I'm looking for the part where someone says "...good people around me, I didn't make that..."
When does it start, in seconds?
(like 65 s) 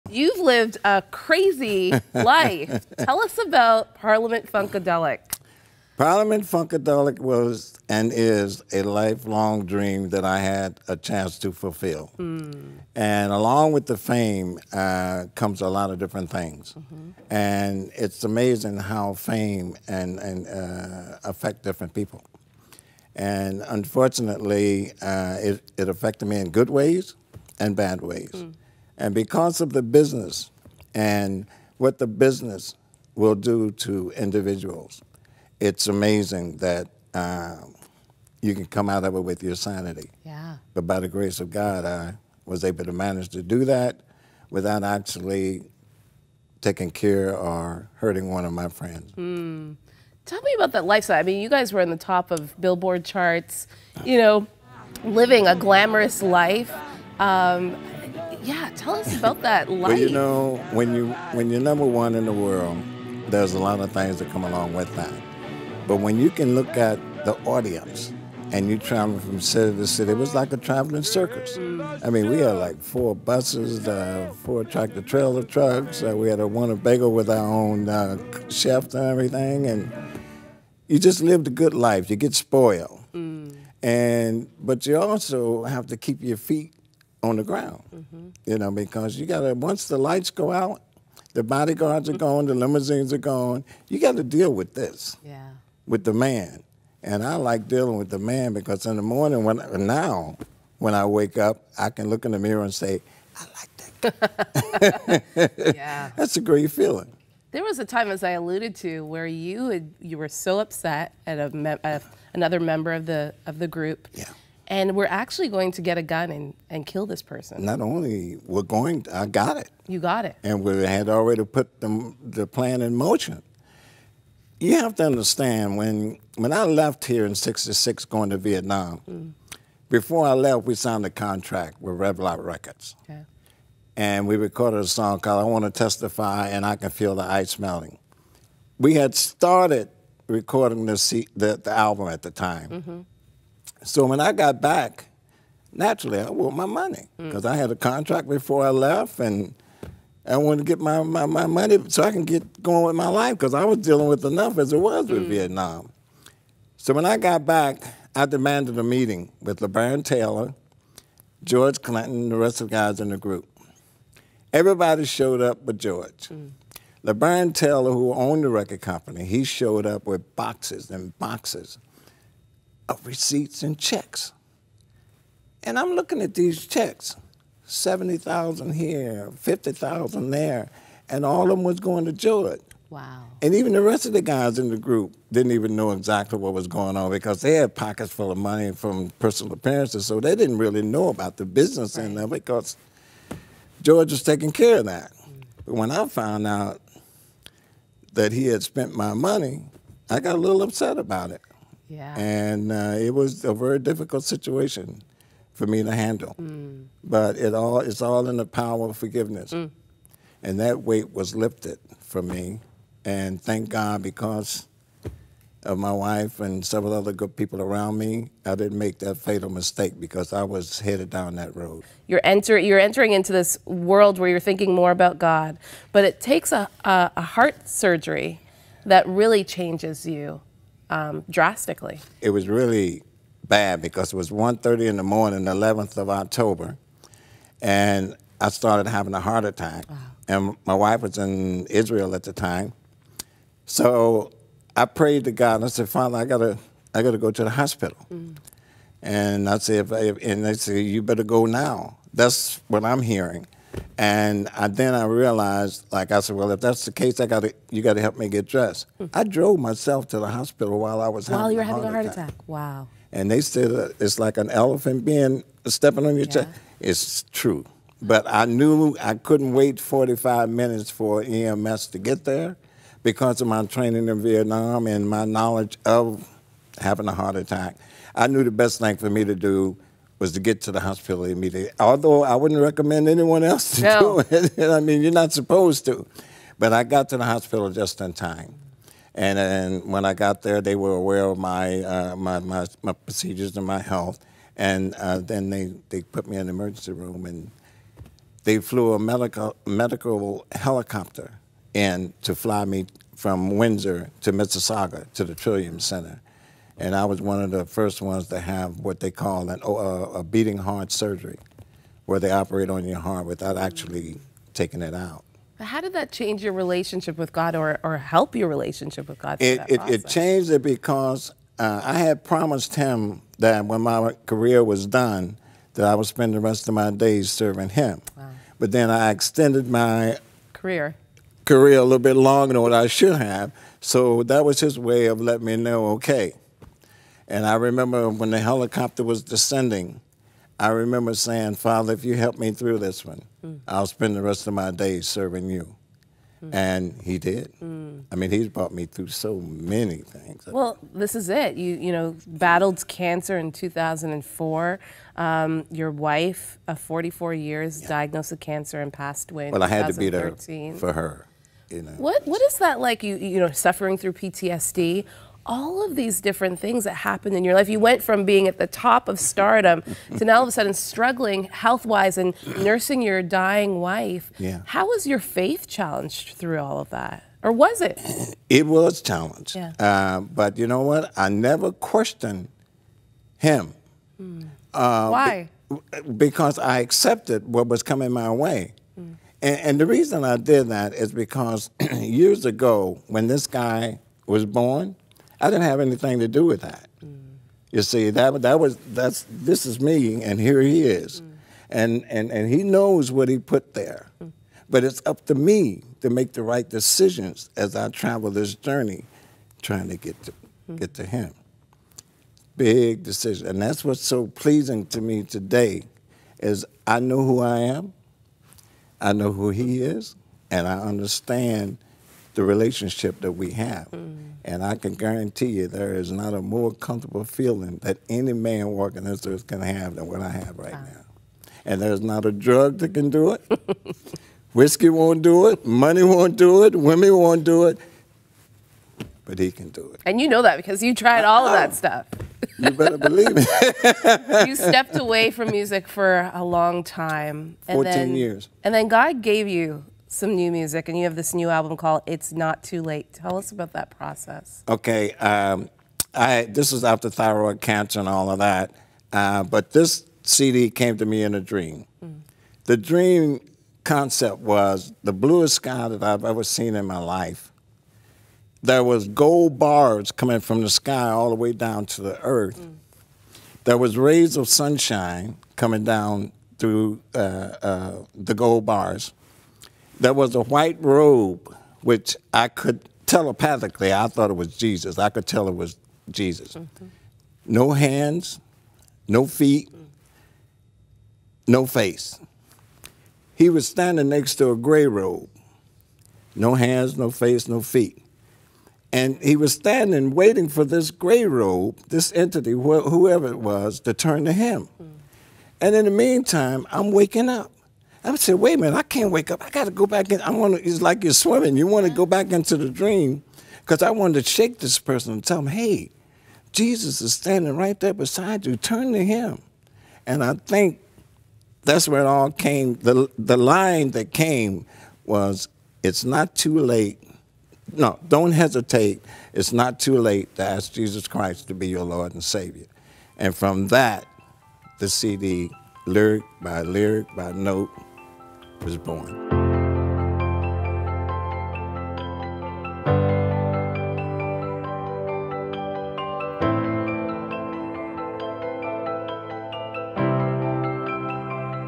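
217 s.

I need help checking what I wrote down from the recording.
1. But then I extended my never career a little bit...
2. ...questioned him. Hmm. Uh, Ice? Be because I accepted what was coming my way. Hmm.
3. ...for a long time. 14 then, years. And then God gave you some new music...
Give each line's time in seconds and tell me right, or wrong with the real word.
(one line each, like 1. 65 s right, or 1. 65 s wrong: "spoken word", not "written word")
1. 328 s wrong: "career", not "never"
2. 381 s wrong: "Why", not "Ice"
3. 445 s right.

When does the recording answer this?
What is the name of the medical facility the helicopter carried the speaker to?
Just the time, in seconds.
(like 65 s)
305 s.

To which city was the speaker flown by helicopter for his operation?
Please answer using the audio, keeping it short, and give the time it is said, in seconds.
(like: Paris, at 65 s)
Mississauga, at 304 s.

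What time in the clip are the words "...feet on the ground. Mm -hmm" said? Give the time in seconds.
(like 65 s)
86 s.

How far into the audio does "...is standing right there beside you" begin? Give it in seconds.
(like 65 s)
517 s.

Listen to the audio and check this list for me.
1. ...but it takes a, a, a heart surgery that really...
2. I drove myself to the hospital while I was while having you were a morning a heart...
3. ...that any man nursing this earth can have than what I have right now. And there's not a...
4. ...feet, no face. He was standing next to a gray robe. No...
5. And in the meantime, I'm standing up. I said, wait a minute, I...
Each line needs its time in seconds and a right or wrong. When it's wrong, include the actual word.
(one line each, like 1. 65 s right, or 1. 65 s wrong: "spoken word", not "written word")
1. 225 s right
2. 259 s wrong: "having", not "morning"
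3. 427 s wrong: "walking", not "nursing"
4. 489 s right
5. 505 s wrong: "waking", not "standing".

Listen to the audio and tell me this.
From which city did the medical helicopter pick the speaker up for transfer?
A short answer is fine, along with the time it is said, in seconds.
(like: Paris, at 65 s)
Windsor, at 303 s.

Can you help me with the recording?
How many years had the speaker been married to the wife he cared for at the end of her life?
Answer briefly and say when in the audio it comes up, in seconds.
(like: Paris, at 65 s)
44 years, at 356 s.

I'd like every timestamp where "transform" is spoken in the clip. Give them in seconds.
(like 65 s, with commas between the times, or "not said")
not said.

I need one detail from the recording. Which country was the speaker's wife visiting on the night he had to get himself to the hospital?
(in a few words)
Israel.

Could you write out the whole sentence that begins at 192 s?
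end of it because George was taking care of that.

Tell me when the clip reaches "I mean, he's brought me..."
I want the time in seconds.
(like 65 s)
348 s.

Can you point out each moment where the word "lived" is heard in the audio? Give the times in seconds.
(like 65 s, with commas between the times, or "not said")
0 s, 81 s.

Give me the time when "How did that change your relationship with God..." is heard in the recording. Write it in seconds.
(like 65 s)
315 s.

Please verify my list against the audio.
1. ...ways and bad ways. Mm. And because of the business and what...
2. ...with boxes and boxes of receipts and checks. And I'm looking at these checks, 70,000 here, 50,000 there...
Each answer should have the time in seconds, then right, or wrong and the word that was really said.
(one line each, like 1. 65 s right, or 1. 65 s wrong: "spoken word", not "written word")
1. 26 s right
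2. 170 s right.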